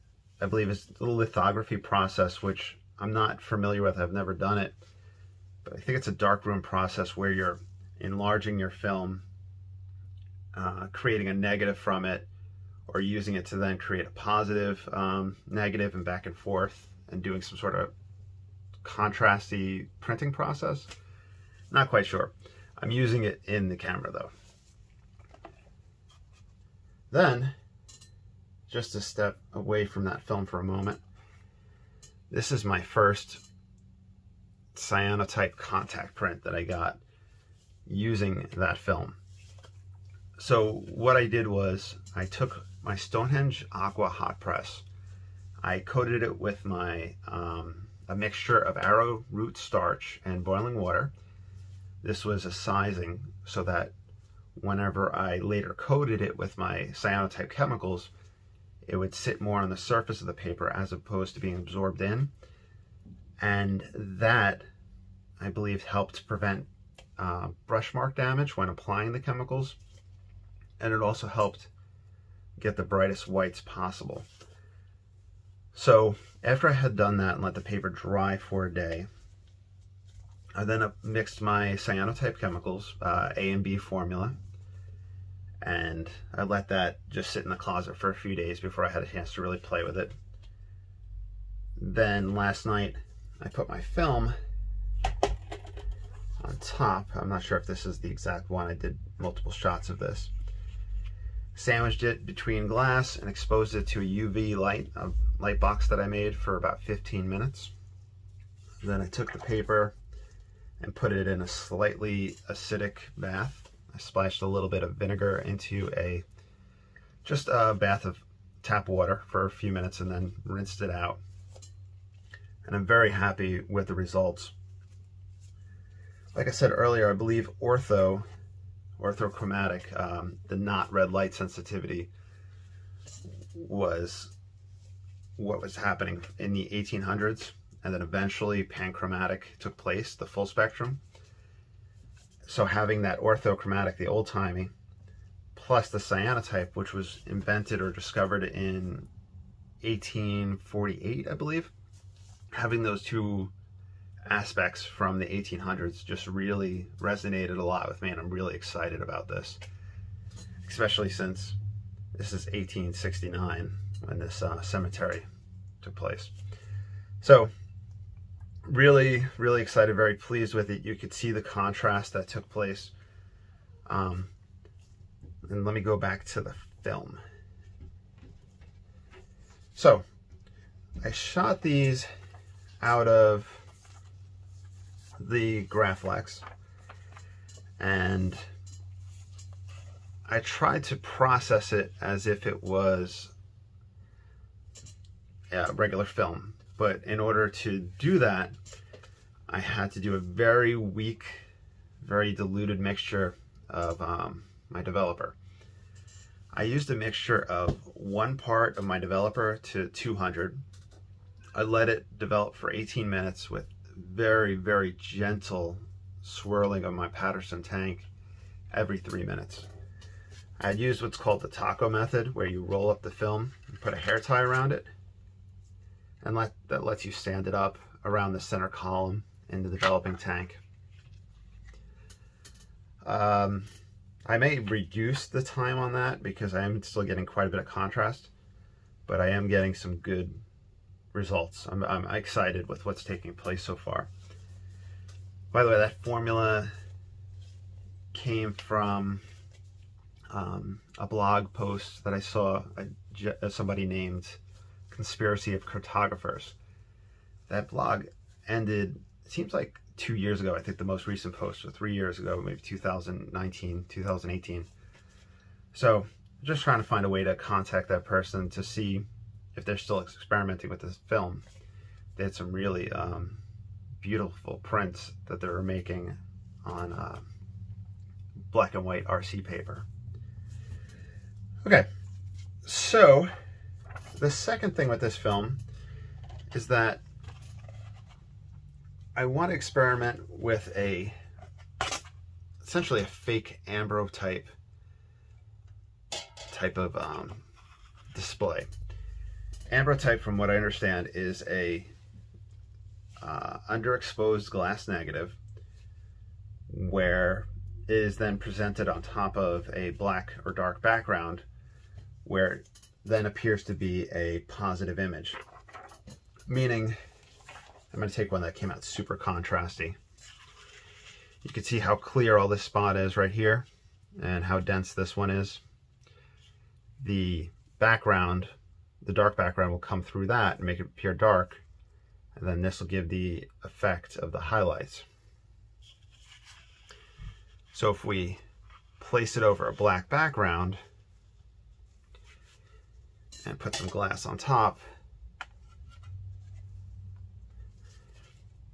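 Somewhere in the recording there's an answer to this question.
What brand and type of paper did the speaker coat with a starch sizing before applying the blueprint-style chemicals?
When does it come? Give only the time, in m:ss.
0:42.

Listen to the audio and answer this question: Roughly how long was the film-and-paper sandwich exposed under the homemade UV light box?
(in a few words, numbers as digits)
15 minutes.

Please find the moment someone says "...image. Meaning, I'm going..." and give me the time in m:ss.
5:14.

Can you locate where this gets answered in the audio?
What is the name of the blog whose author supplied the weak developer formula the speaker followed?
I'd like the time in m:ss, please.
4:14.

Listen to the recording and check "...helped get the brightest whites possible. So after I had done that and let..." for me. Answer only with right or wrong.
right.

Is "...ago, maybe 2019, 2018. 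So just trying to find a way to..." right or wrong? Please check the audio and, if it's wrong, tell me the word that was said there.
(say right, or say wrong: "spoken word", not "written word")
right.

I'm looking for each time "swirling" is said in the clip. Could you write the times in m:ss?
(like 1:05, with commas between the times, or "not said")
3:36.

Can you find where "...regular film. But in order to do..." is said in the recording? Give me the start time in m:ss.
3:15.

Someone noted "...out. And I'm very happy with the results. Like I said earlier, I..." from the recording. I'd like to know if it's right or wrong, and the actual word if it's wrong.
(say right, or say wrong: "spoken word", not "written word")
right.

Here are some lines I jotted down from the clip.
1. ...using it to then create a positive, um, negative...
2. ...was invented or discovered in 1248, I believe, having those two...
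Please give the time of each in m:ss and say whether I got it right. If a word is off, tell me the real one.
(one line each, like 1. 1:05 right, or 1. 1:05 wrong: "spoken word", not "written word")
1. 0:12 right
2. 2:26 wrong: "1848", not "1248".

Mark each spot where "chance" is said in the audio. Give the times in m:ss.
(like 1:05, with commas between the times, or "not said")
1:29.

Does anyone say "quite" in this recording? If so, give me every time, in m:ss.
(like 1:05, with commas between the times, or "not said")
0:21, 3:57.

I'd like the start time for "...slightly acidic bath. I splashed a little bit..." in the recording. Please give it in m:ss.
1:51.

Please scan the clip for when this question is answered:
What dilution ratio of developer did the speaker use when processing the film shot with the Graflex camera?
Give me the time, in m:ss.
3:27.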